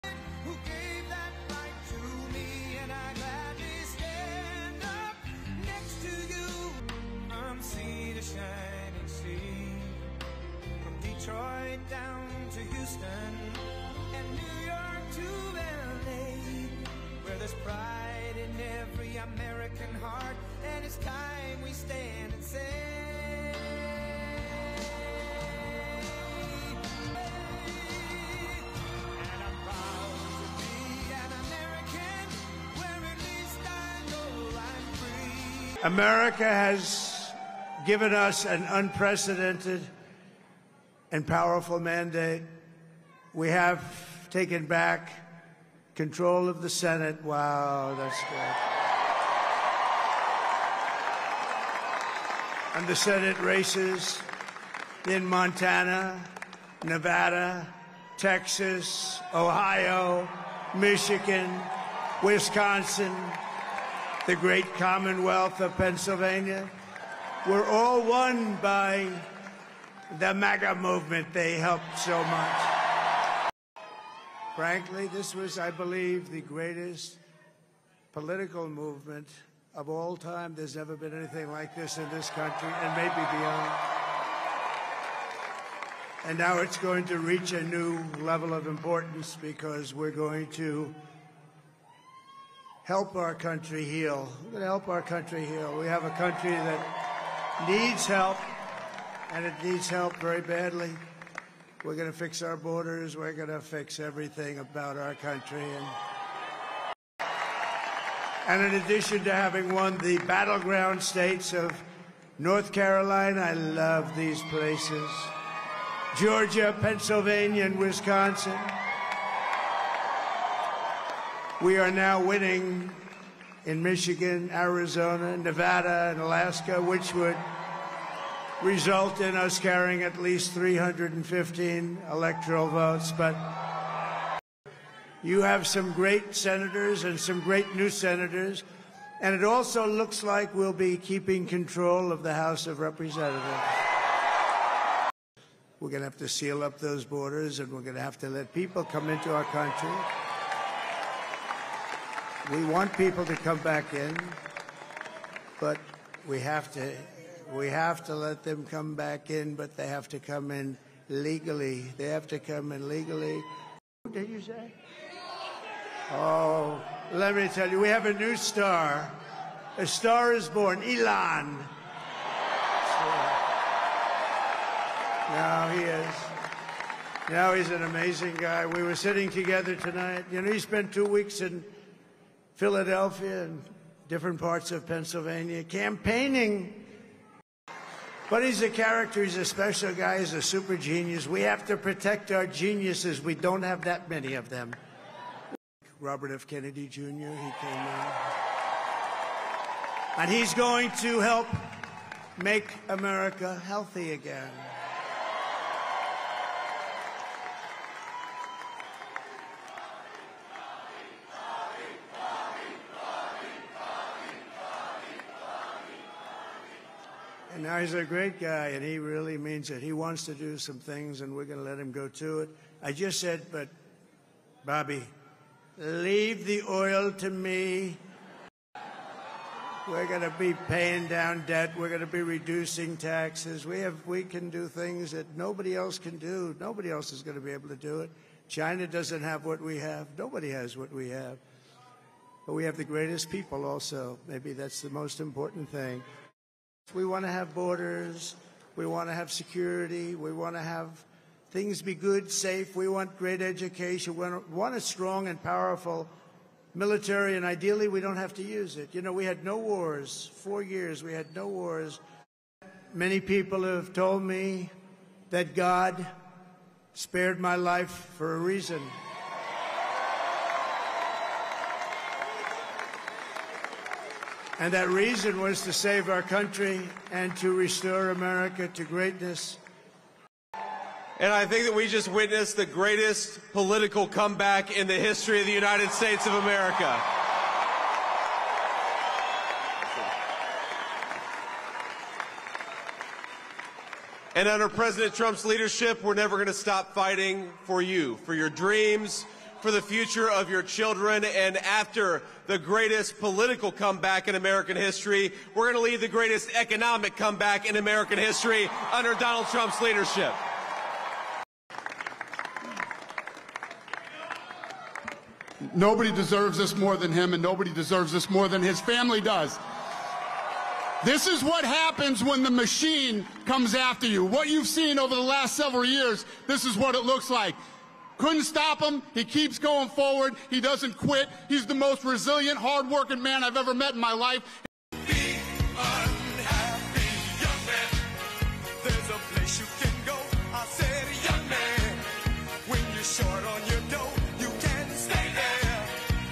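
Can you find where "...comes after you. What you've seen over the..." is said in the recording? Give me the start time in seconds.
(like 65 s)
323 s.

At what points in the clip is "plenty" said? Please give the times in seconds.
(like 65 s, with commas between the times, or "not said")
not said.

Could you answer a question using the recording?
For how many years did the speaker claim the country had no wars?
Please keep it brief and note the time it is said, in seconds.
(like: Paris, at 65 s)
4, at 260 s.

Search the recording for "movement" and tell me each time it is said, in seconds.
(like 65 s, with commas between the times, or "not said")
70 s, 78 s.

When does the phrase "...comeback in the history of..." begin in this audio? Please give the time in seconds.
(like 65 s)
284 s.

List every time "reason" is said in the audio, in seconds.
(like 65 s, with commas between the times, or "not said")
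268 s, 274 s.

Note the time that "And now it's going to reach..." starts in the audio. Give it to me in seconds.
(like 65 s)
86 s.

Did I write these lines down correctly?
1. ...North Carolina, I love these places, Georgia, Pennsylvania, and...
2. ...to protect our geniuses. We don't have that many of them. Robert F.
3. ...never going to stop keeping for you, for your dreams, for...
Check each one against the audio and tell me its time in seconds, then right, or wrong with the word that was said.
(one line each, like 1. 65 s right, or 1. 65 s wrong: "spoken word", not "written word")
1. 112 s right
2. 191 s right
3. 296 s wrong: "fighting", not "keeping".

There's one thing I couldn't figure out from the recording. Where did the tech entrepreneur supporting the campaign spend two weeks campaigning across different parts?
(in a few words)
Philadelphia.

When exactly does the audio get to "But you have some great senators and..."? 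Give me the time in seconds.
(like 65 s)
133 s.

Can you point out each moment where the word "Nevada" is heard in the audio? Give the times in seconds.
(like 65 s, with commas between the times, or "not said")
56 s, 125 s.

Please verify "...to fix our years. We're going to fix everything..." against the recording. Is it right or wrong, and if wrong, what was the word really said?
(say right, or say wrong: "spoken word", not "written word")
wrong: "borders", not "years".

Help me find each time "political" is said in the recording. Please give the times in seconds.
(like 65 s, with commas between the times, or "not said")
78 s, 283 s, 303 s.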